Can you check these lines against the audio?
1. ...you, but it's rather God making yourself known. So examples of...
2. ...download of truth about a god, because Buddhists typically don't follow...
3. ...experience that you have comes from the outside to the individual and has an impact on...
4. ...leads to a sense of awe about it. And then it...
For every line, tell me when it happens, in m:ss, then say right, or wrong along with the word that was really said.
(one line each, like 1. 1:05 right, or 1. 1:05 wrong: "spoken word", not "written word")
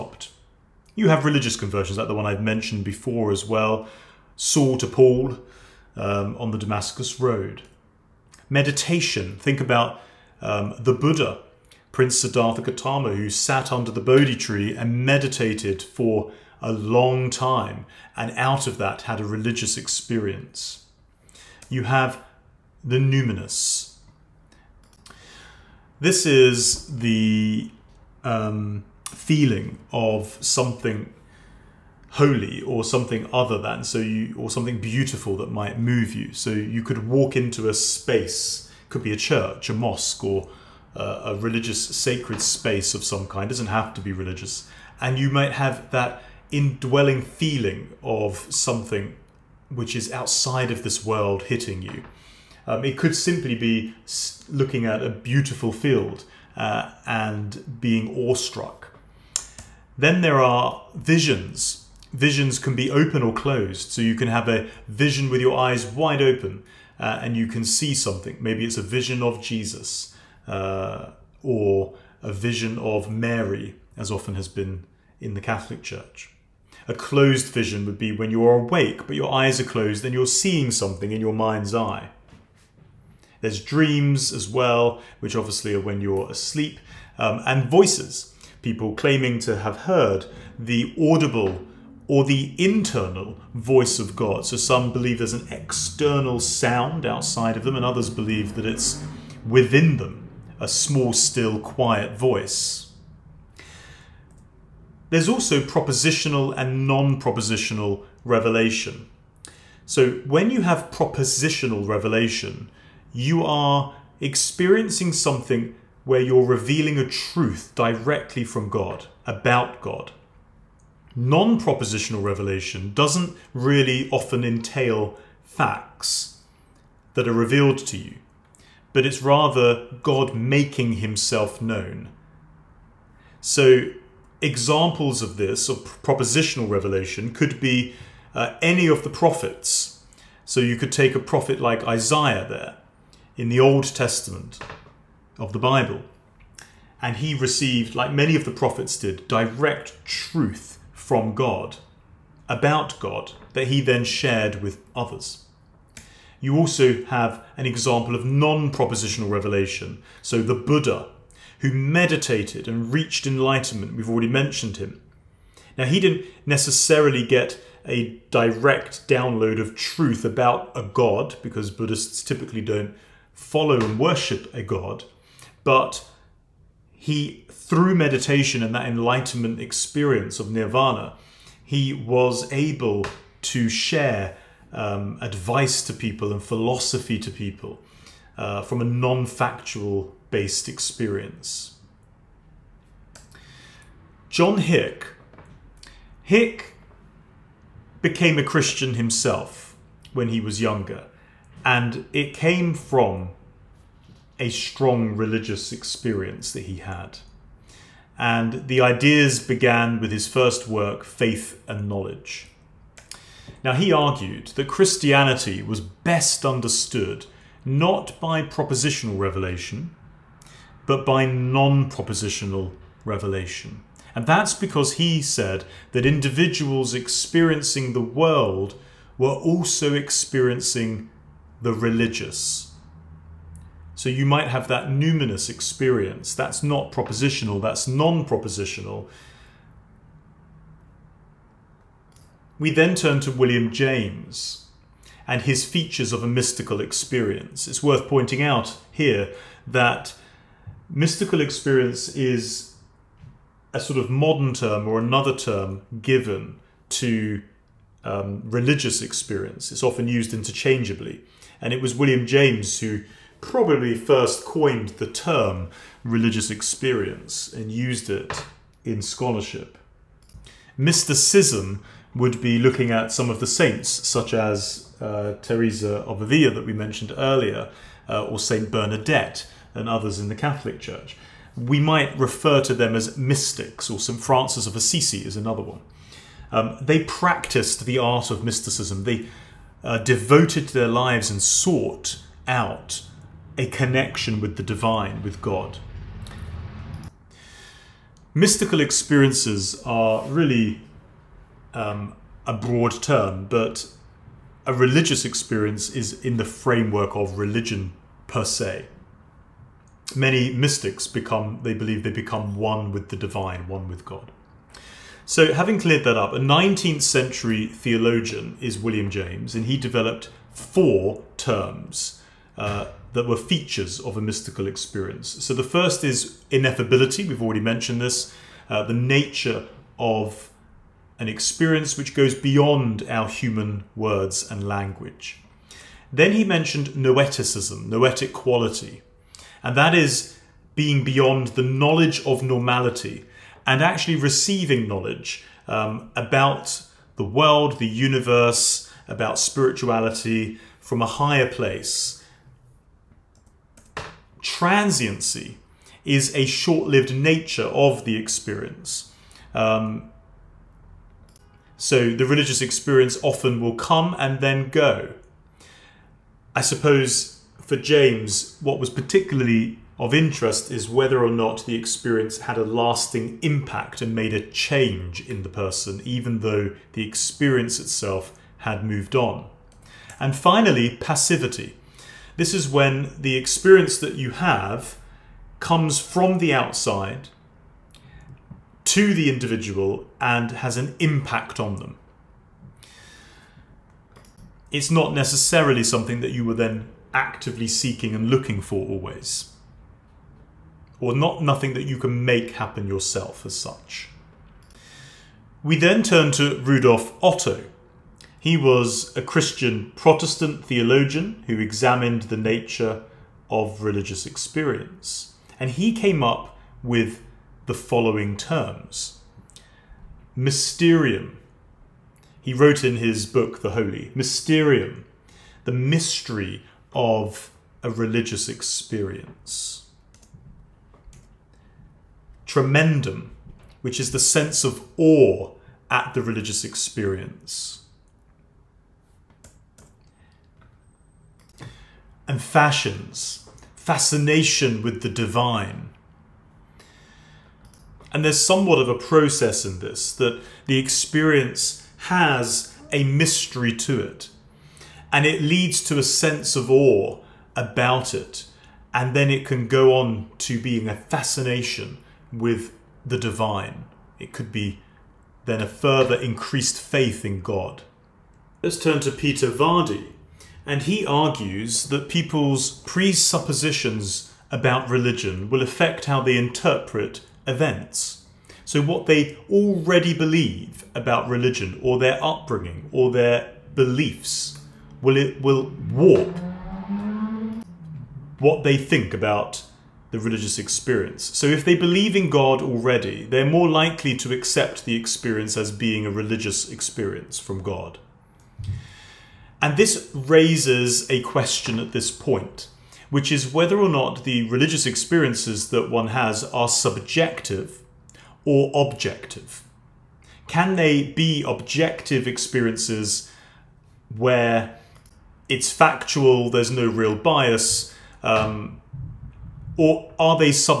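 1. 2:07 wrong: "himself", not "yourself"
2. 2:49 right
3. 6:23 right
4. 7:35 right.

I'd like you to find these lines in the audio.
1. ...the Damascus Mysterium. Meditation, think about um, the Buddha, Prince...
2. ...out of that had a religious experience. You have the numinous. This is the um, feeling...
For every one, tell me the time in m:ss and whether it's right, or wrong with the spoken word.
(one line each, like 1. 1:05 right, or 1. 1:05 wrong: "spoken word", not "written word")
1. 0:06 wrong: "Road", not "Mysterium"
2. 0:18 right.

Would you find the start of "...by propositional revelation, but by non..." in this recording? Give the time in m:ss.
3:38.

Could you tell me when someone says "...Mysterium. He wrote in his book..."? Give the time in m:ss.
7:00.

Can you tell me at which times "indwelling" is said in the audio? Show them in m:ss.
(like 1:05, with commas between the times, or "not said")
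0:46.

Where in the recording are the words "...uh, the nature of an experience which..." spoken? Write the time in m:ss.
5:28.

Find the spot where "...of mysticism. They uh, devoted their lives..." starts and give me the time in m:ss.
4:48.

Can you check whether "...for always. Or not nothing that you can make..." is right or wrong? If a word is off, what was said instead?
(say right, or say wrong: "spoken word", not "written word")
right.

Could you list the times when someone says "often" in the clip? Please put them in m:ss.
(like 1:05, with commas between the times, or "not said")
1:14, 2:04, 4:19, 6:03.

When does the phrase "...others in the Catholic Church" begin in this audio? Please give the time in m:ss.
4:39.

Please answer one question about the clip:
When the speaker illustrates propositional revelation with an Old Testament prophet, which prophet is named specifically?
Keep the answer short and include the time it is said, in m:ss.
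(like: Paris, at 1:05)
Isaiah, at 2:21.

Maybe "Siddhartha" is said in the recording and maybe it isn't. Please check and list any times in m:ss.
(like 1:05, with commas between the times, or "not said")
0:12.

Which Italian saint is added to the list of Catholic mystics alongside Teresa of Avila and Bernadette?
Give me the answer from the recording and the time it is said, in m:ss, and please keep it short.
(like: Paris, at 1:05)
St. Francis of Assisi, at 4:43.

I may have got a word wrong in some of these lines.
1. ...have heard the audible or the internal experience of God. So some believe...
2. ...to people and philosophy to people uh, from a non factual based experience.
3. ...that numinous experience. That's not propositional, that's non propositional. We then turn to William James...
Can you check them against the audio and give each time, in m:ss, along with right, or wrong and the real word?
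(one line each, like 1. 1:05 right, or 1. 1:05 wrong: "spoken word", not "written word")
1. 1:29 wrong: "voice", not "experience"
2. 3:05 right
3. 3:54 right.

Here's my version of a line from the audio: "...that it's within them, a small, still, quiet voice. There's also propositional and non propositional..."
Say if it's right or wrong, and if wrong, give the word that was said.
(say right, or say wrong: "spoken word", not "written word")
right.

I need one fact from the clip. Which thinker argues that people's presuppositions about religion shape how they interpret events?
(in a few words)
Peter Vardy.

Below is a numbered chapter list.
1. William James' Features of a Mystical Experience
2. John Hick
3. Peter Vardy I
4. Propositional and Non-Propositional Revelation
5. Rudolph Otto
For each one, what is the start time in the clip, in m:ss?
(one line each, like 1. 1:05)
1. 4:02
2. 3:13
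3. 7:48
4. 1:44
5. 6:44.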